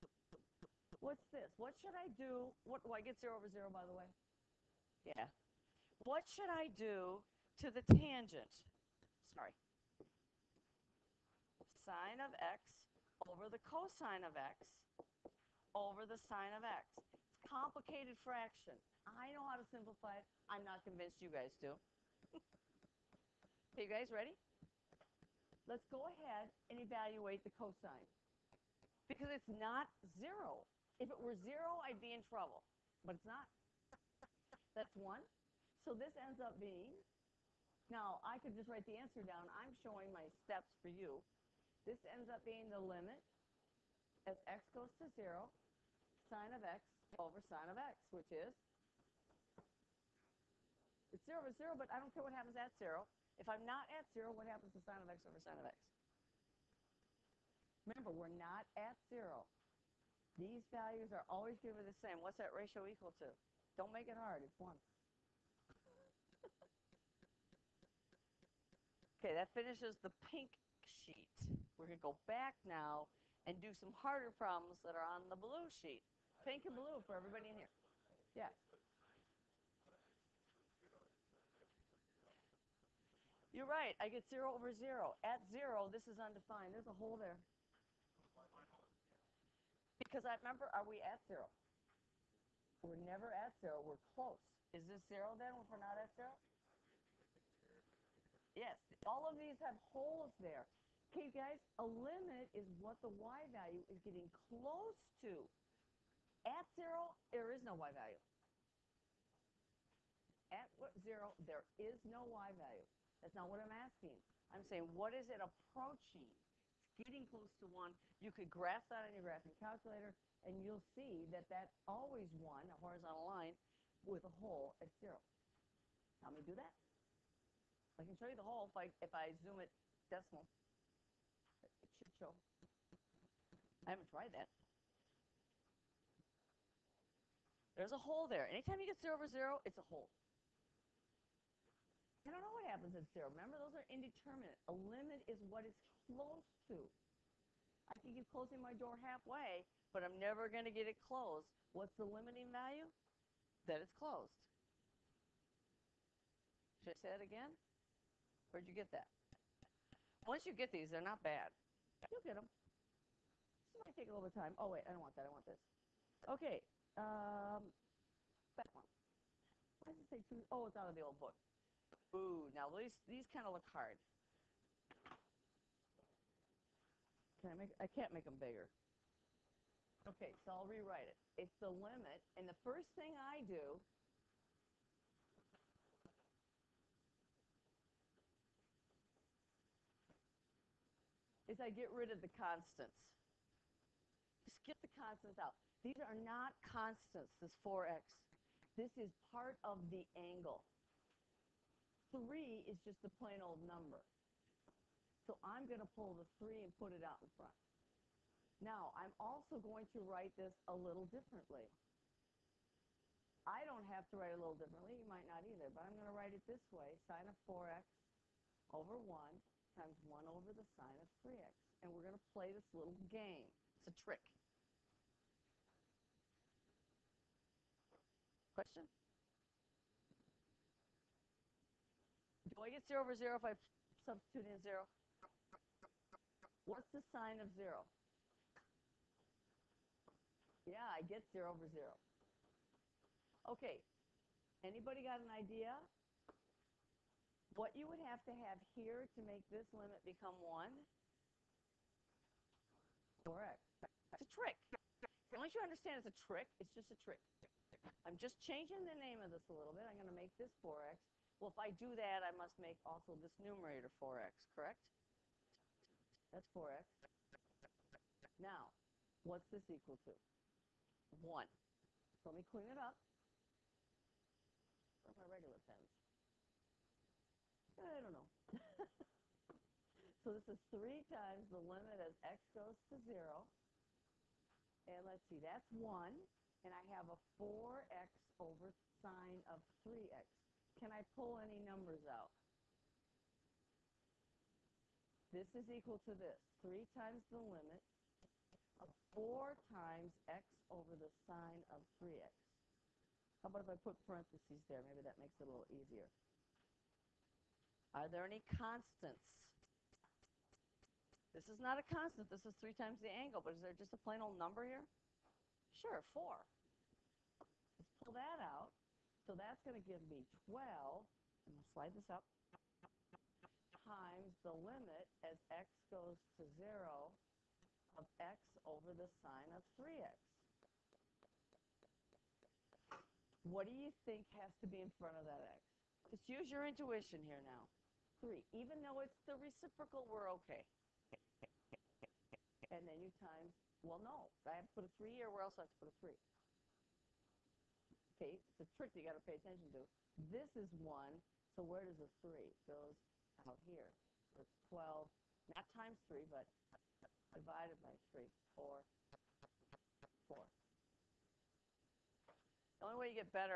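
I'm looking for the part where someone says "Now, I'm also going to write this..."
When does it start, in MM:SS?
03:28.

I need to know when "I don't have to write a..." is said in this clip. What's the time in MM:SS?
03:33.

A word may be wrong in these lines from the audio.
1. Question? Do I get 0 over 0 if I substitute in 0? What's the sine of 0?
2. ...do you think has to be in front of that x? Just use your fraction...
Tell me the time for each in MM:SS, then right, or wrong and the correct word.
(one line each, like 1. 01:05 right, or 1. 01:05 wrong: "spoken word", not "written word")
1. 03:48 right
2. 05:33 wrong: "intuition", not "fraction".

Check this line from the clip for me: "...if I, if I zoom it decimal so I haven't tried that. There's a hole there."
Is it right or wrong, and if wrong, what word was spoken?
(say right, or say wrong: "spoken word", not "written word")
right.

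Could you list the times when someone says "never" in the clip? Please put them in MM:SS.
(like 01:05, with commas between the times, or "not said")
01:33, 02:30.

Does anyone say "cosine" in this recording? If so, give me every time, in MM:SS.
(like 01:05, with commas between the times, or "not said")
00:13, 00:27.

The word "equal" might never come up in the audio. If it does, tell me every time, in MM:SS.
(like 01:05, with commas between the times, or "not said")
01:02, 04:29, 04:55.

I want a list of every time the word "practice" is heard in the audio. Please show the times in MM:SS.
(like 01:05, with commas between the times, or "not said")
not said.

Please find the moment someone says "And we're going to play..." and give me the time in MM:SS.
03:41.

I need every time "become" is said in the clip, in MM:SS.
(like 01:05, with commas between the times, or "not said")
04:10.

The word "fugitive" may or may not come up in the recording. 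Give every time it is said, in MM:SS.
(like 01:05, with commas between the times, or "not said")
not said.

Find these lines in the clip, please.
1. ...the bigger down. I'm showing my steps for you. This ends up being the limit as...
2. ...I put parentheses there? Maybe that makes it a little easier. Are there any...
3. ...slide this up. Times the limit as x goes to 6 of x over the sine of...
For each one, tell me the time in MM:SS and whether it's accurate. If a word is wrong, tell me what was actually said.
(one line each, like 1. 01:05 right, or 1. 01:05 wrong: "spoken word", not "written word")
1. 00:38 wrong: "answer", not "bigger"
2. 05:03 right
3. 05:21 wrong: "0", not "6".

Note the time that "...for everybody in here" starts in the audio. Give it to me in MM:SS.
01:17.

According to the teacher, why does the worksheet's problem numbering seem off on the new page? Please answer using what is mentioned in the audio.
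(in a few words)
old book.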